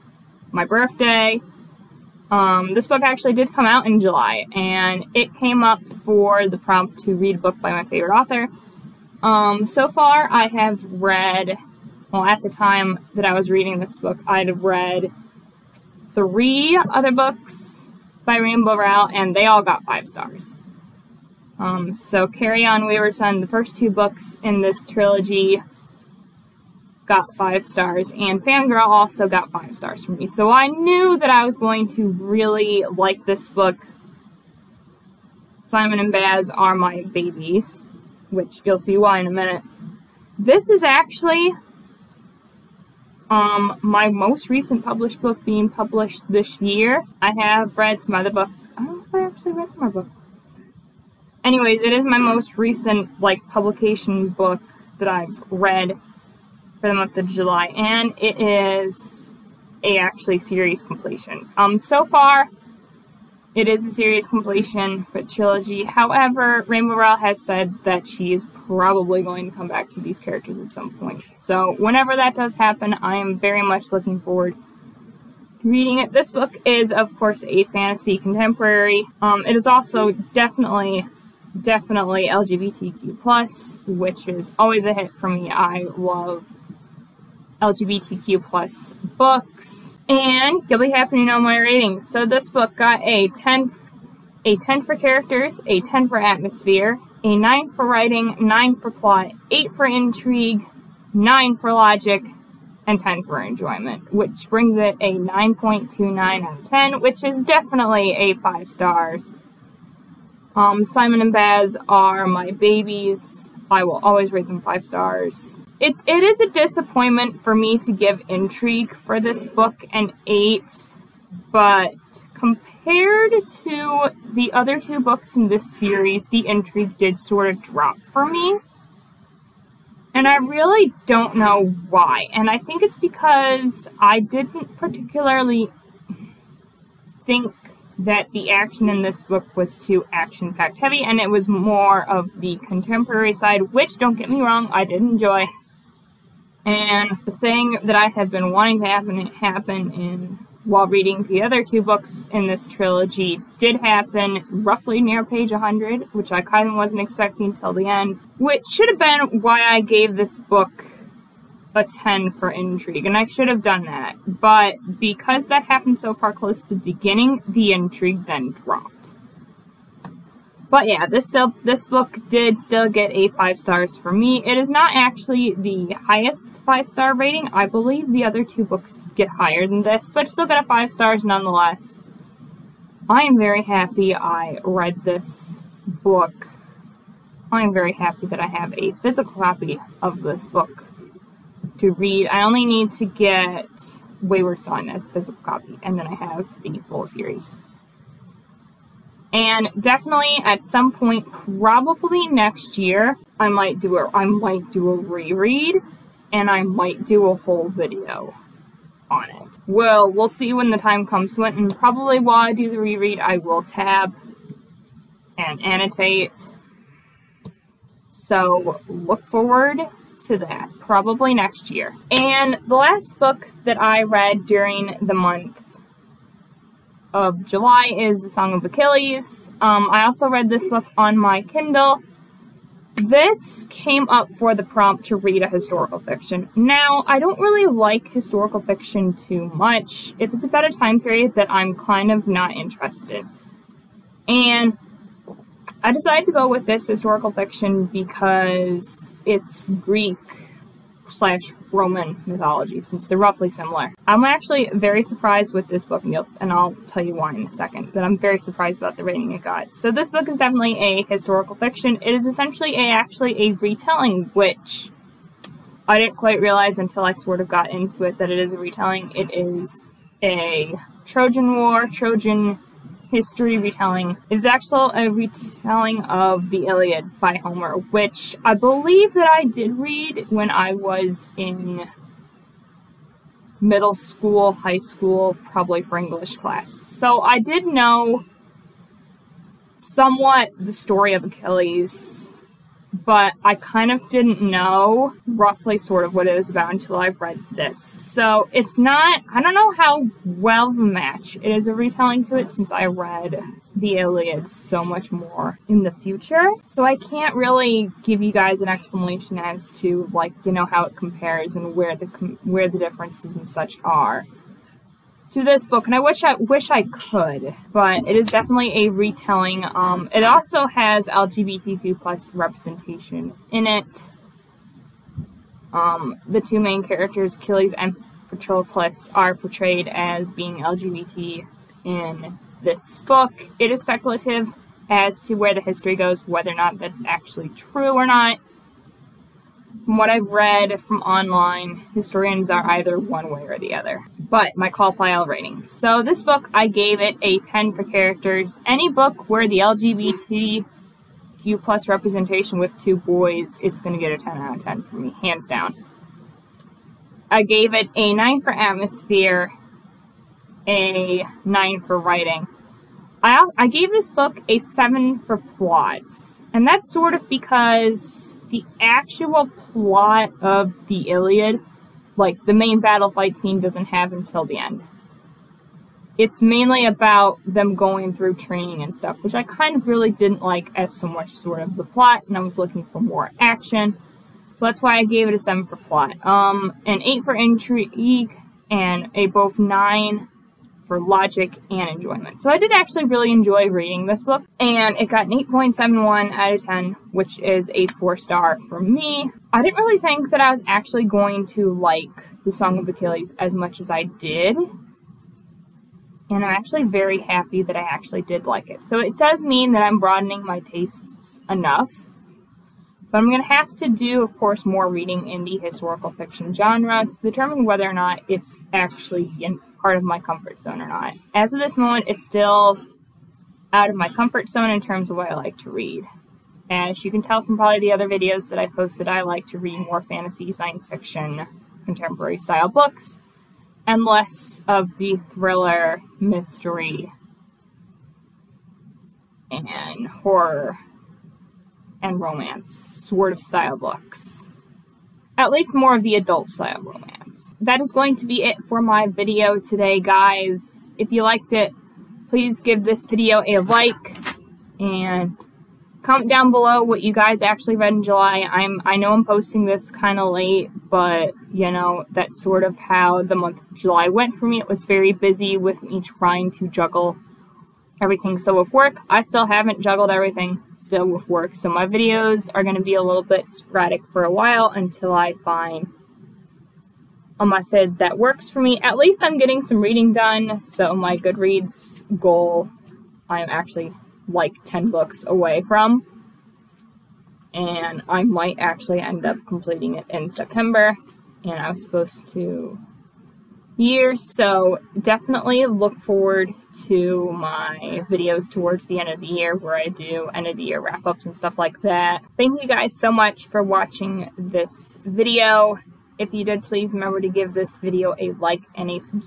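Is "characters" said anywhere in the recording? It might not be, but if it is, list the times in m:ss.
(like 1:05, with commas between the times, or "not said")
1:10, 1:34, 5:26, 5:47.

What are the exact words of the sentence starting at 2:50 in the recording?
But yeah, this still this book did still get a five stars for me.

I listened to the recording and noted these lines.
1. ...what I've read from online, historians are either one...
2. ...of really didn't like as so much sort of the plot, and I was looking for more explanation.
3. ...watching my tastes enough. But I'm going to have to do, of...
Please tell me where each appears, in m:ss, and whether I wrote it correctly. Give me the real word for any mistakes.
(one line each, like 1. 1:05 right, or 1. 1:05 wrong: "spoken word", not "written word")
1. 5:39 right
2. 6:19 wrong: "action", not "explanation"
3. 6:49 wrong: "broadening", not "watching".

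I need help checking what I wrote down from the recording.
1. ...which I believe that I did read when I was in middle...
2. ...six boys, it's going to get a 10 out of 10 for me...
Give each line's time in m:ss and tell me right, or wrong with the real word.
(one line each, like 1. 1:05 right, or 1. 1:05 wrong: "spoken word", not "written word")
1. 4:37 right
2. 5:52 wrong: "two", not "six".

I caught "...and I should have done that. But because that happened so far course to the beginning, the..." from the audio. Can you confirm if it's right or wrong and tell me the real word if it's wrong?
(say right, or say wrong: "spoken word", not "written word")
wrong: "close", not "course".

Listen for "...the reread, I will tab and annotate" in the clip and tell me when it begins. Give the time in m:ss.
3:32.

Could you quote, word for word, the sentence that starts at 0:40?
This is actually um, my most recent published book being published this year.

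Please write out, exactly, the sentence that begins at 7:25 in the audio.
At least more of the adult style romance that is going to be it for my video today, guys.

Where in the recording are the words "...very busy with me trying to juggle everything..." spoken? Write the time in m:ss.
7:44.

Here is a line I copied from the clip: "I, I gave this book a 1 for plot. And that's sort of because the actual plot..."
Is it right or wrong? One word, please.
wrong.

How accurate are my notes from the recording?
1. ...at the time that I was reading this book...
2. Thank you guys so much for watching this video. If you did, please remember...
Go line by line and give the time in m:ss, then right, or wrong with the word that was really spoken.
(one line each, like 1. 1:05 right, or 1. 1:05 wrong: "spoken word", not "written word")
1. 0:12 right
2. 8:22 right.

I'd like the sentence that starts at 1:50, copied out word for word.
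Um, Simon and Baz are my babies.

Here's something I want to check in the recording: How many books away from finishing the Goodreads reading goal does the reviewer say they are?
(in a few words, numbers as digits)
10.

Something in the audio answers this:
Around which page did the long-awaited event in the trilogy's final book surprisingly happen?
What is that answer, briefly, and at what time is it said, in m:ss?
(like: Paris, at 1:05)
100, at 2:35.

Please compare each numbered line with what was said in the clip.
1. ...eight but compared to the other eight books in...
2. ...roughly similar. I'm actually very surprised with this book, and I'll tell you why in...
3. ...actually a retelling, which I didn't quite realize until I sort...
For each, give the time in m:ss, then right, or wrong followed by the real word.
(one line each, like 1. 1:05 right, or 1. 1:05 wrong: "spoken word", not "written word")
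1. 2:00 wrong: "two", not "eight"
2. 4:13 right
3. 4:22 right.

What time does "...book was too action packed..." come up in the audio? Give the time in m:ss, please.
2:19.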